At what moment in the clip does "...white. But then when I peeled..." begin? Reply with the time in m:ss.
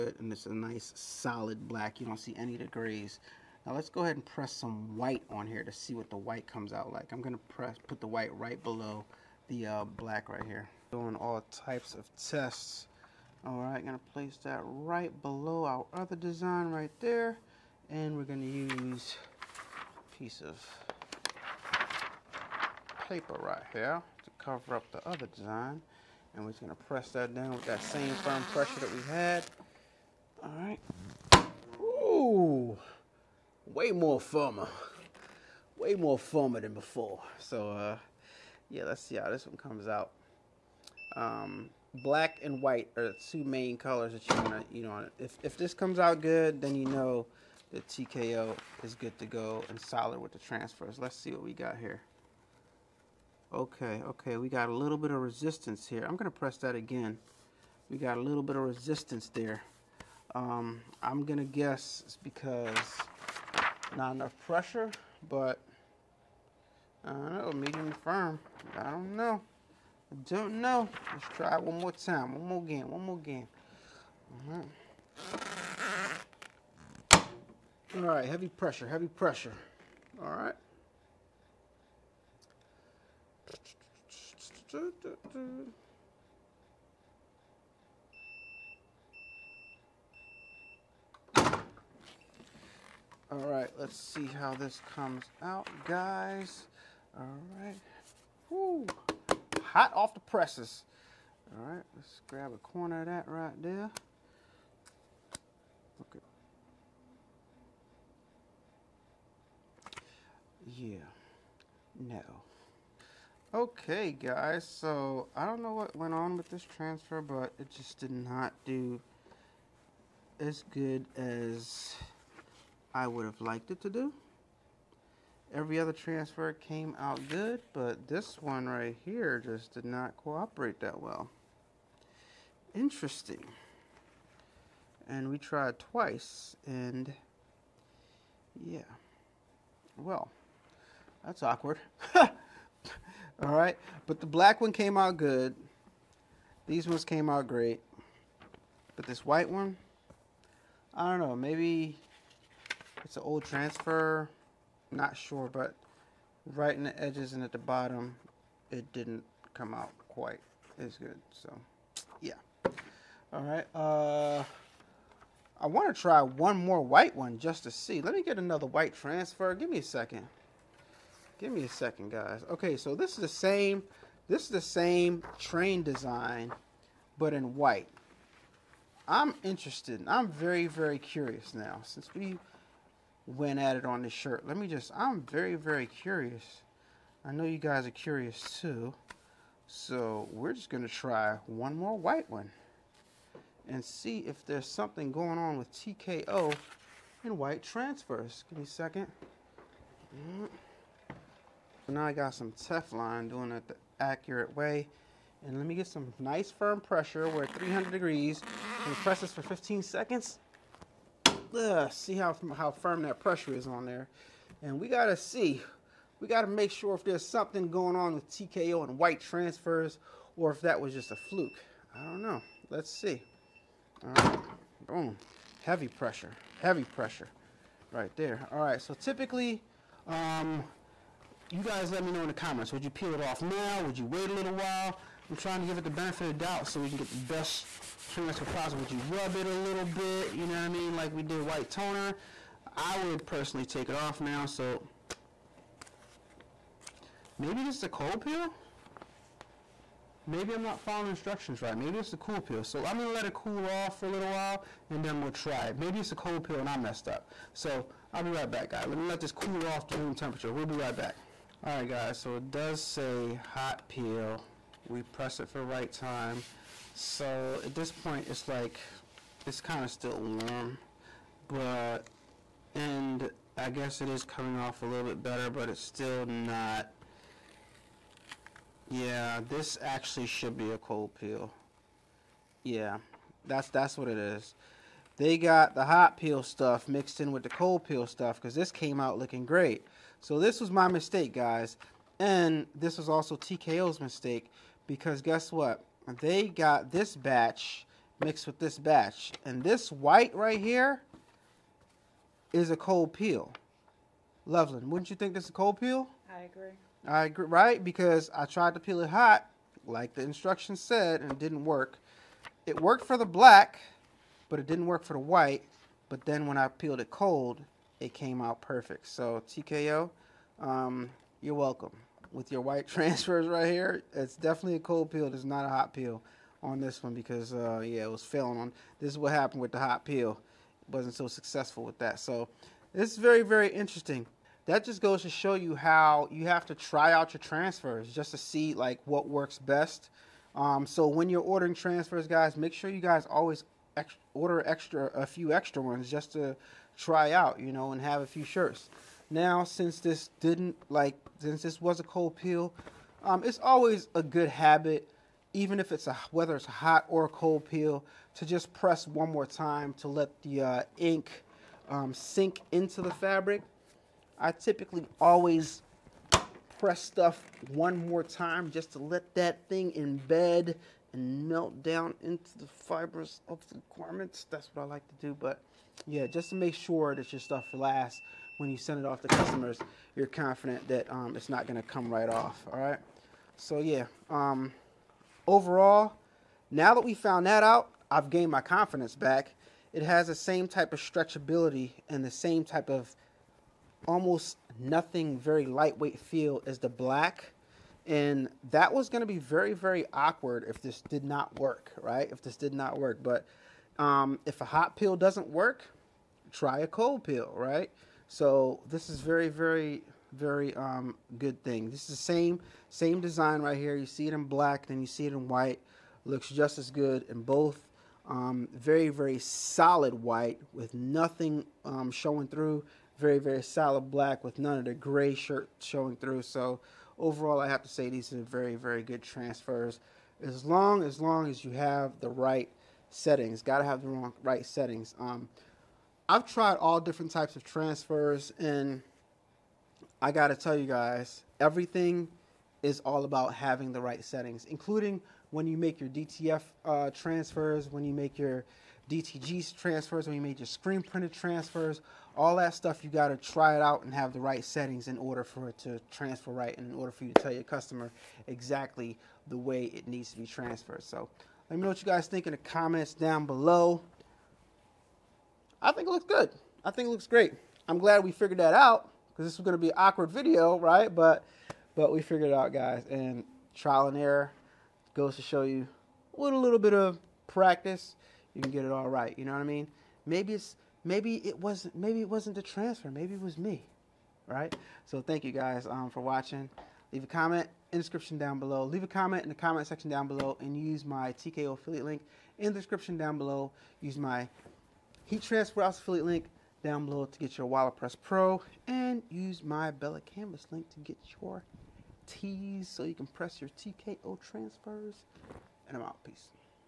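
5:15.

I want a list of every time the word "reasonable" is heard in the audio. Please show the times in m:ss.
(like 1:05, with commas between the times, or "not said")
not said.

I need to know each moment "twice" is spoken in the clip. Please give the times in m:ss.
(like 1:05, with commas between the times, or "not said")
2:15.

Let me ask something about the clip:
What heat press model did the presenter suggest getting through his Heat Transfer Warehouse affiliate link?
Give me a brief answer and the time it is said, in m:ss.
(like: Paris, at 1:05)
Wallet Press Pro, at 8:17.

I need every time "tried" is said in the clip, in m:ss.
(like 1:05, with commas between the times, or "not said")
2:15, 5:08, 7:16.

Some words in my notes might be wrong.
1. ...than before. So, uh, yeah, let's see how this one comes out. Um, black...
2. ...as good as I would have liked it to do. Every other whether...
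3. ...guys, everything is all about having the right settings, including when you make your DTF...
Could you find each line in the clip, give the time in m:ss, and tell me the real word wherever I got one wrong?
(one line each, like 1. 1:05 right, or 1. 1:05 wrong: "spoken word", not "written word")
1. 0:36 right
2. 2:00 wrong: "transfer", not "whether"
3. 7:20 right.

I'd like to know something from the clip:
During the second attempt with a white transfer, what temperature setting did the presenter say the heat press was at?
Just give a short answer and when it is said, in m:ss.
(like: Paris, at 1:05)
300 degrees, at 3:27.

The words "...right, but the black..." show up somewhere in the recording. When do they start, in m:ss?
2:23.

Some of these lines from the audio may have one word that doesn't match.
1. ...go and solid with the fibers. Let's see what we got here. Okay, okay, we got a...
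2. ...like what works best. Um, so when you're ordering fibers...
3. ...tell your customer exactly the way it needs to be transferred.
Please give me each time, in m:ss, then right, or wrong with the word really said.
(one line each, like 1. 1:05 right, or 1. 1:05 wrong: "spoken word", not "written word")
1. 0:49 wrong: "transfers", not "fibers"
2. 5:38 wrong: "transfers", not "fibers"
3. 7:37 right.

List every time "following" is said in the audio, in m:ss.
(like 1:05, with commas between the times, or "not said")
4:10.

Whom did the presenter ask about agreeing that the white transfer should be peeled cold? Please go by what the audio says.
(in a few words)
Loveland.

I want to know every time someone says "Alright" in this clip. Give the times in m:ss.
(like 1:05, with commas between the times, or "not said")
0:13, 0:30.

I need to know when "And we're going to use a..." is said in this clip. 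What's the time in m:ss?
0:17.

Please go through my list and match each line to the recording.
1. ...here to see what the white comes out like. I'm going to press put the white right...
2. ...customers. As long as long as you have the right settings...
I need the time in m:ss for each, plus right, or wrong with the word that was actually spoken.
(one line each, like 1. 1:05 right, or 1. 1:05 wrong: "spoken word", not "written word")
1. 0:05 right
2. 7:09 wrong: "transfers", not "customers".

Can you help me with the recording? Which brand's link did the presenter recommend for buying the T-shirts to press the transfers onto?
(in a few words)
Bella Canvas.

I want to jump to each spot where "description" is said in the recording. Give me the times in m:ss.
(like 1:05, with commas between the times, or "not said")
8:07, 8:12.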